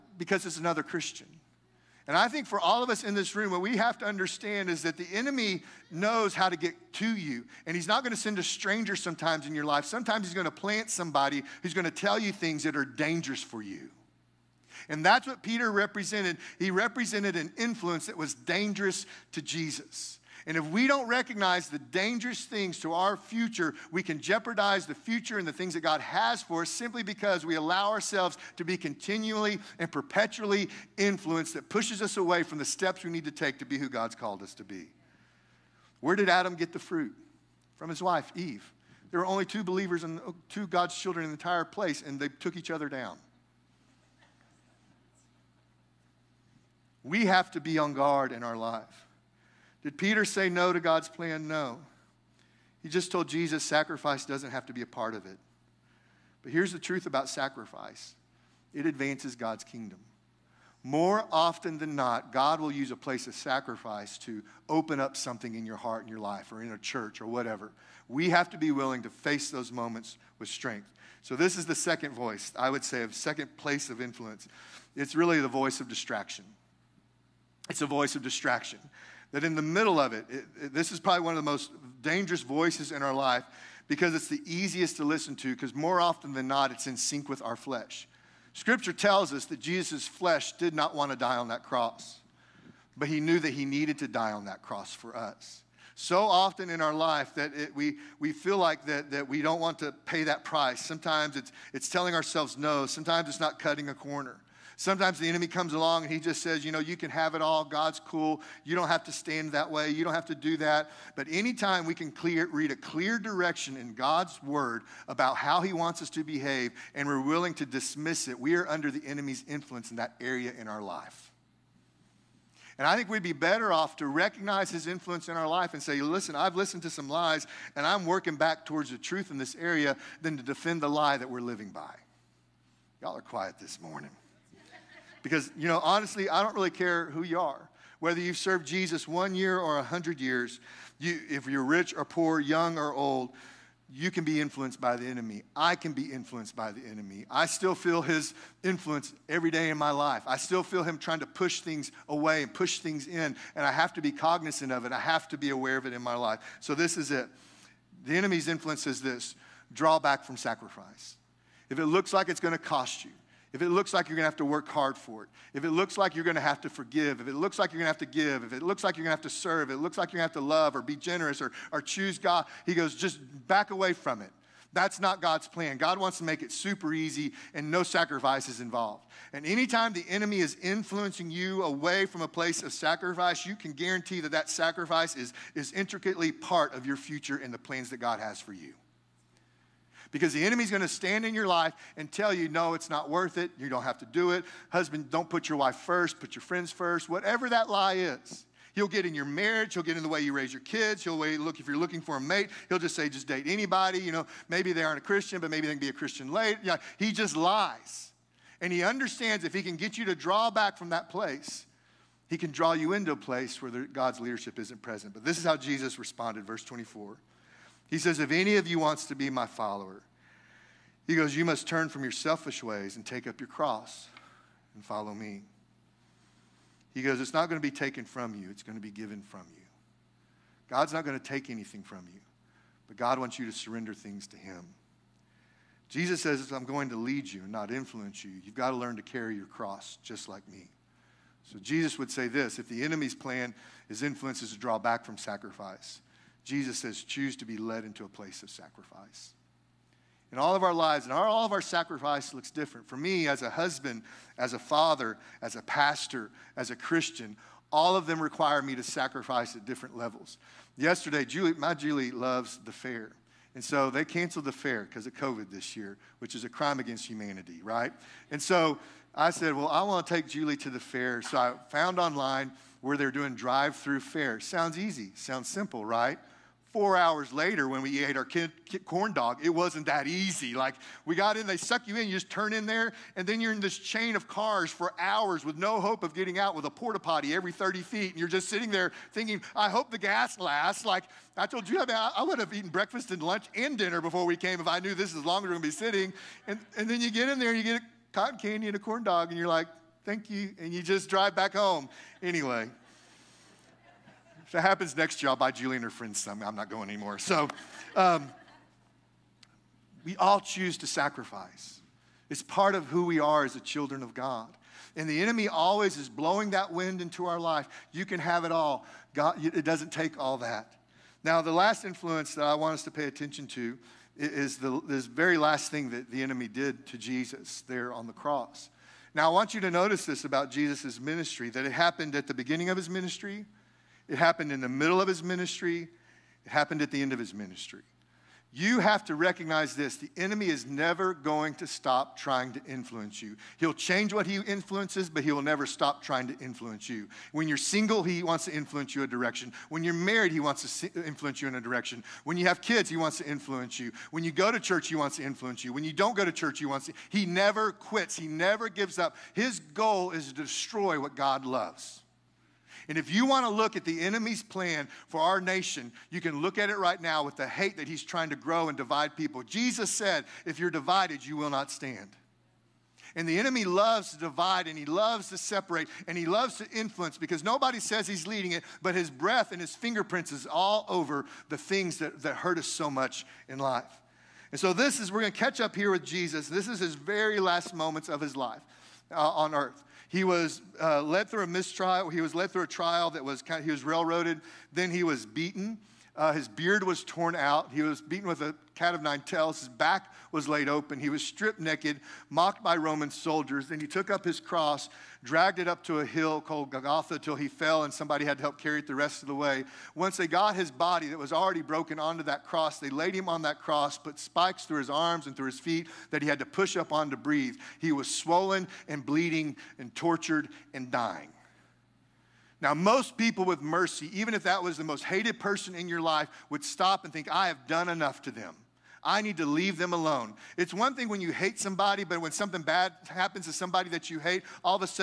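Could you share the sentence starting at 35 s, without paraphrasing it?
Where did Adam get the fruit?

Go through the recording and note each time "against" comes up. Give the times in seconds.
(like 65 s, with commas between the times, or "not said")
266 s.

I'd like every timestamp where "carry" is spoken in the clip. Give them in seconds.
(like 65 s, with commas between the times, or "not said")
239 s, 408 s.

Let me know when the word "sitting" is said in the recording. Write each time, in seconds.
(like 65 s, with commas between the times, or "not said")
288 s, 295 s.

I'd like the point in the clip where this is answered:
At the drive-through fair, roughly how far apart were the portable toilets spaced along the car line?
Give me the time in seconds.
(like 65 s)
287 s.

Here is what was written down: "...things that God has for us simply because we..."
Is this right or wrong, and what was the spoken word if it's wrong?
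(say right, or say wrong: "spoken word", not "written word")
right.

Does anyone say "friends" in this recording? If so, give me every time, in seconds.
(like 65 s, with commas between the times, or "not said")
196 s, 305 s.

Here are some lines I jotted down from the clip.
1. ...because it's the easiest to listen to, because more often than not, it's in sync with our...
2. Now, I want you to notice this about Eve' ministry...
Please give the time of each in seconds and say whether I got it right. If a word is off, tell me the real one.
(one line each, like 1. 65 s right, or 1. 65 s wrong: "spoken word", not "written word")
1. 83 s right
2. 329 s wrong: "Jesus", not "Eve".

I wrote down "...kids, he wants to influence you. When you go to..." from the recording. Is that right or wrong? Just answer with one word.
right.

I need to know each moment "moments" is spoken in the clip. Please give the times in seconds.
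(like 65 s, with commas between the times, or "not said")
69 s, 387 s.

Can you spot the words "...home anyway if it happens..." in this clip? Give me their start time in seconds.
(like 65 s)
301 s.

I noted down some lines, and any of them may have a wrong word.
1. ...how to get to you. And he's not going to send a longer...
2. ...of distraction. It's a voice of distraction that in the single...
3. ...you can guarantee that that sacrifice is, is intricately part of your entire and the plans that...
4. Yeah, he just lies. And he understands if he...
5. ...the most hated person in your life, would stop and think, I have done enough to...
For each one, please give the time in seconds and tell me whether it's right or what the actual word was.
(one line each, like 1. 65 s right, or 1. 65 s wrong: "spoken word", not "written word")
1. 6 s wrong: "stranger", not "longer"
2. 75 s wrong: "middle", not "single"
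3. 183 s wrong: "future", not "entire"
4. 206 s right
5. 424 s right.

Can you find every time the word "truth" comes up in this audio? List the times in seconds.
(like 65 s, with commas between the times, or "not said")
56 s, 128 s.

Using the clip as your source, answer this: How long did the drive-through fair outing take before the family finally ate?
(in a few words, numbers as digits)
4 hours.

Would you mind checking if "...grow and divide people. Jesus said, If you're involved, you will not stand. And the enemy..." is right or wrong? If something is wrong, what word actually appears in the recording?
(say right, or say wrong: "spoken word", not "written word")
wrong: "divided", not "involved".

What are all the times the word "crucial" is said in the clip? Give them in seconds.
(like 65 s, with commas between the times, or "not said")
not said.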